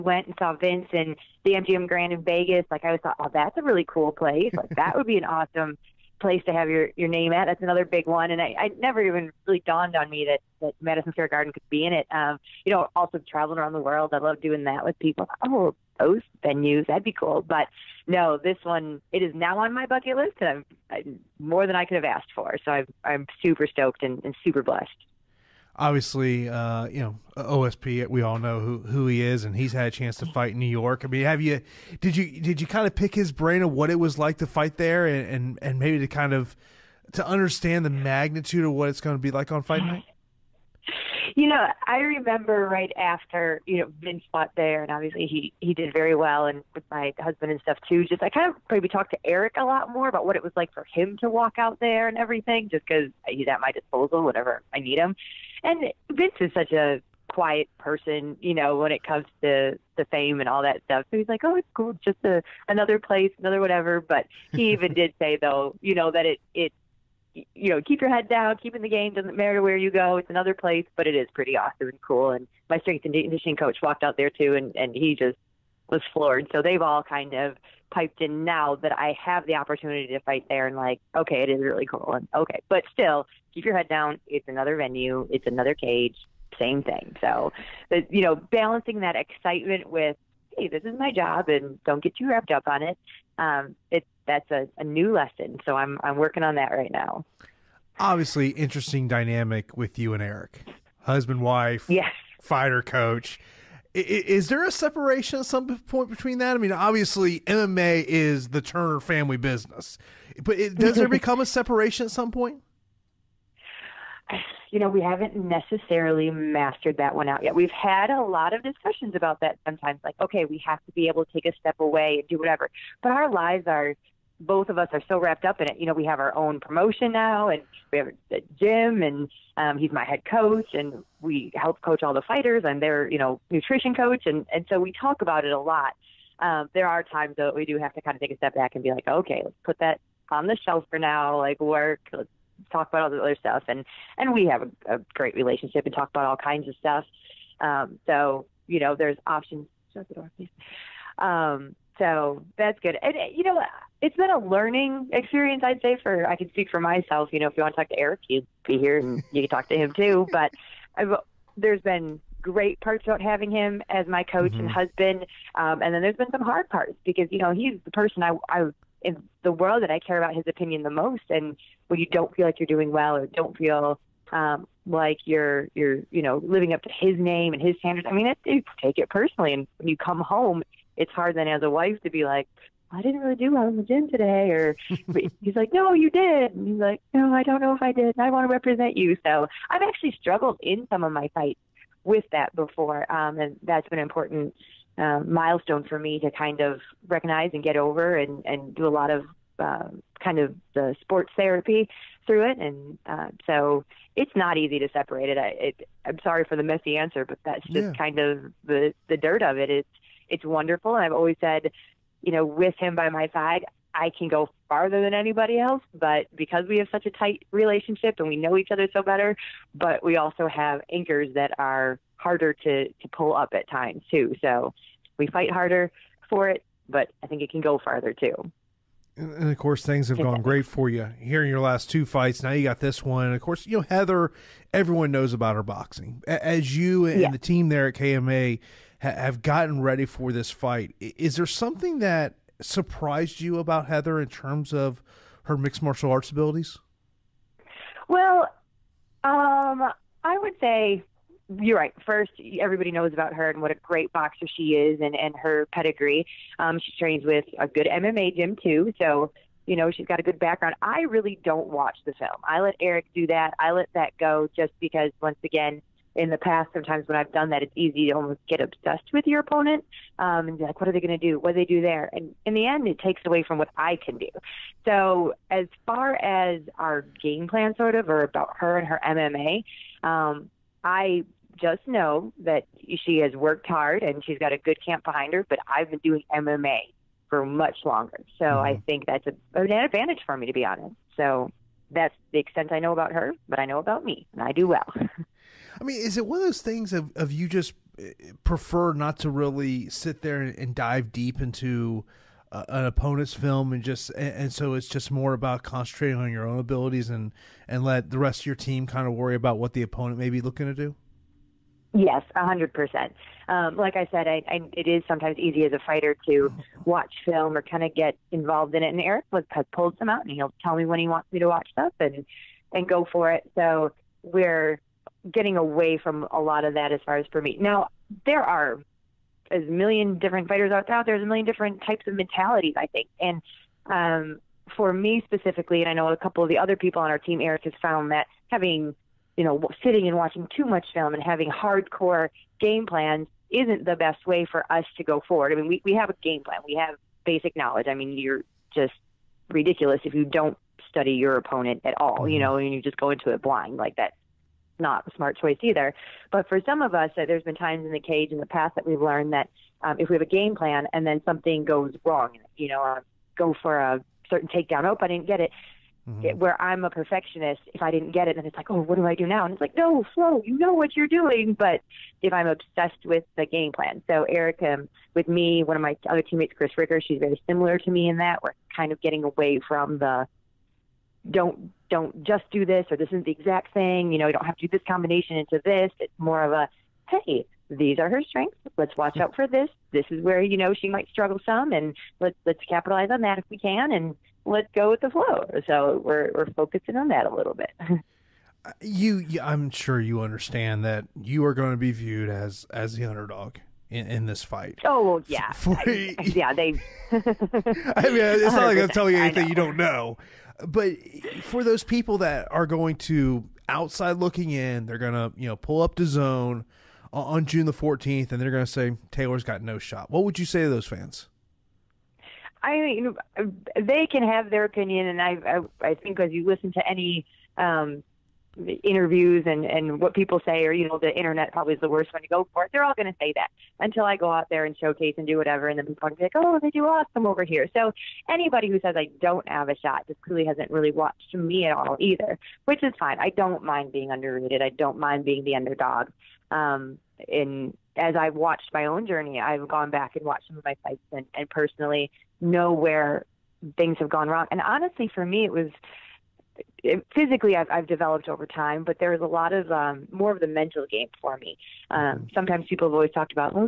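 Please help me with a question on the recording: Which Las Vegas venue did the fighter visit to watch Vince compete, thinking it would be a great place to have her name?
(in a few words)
MGM Grand.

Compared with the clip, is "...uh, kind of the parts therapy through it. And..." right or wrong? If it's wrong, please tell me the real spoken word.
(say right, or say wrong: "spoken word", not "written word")
wrong: "sports", not "parts".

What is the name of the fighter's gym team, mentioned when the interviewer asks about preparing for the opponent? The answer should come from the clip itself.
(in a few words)
KMA.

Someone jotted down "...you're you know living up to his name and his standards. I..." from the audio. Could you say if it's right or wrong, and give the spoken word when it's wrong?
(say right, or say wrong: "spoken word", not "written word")
right.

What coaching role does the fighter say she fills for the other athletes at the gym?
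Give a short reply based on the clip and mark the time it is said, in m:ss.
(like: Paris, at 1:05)
nutrition coach, at 2:13.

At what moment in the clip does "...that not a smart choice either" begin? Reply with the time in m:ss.
5:53.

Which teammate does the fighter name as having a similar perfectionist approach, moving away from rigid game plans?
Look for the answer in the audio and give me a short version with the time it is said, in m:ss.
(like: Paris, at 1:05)
Chris Ricker, at 6:16.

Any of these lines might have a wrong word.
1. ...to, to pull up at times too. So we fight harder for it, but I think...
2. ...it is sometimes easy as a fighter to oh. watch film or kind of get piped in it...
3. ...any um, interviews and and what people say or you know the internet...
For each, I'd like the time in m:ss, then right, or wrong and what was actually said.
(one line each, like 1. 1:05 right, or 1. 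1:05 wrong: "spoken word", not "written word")
1. 3:42 right
2. 5:14 wrong: "involved", not "piped"
3. 7:06 right.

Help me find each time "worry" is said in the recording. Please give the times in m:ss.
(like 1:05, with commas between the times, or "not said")
5:09.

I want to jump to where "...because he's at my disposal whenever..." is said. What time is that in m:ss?
0:52.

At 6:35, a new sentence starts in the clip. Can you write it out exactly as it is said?
So we're we're focusing on that a little bit.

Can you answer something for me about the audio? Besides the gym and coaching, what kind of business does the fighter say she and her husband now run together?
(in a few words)
promotion.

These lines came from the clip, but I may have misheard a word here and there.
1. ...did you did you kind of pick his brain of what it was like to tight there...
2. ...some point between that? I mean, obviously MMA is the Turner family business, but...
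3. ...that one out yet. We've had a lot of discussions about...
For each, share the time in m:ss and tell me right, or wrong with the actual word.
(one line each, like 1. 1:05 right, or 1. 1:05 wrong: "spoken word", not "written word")
1. 0:32 wrong: "fight", not "tight"
2. 1:45 right
3. 1:56 right.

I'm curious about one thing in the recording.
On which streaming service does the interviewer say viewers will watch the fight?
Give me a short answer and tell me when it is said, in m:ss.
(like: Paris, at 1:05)
DAZN, at 6:55.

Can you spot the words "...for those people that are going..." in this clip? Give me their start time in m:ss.
6:51.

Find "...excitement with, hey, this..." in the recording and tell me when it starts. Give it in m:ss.
1:29.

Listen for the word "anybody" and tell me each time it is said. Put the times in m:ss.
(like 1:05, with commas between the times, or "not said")
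3:35, 7:18.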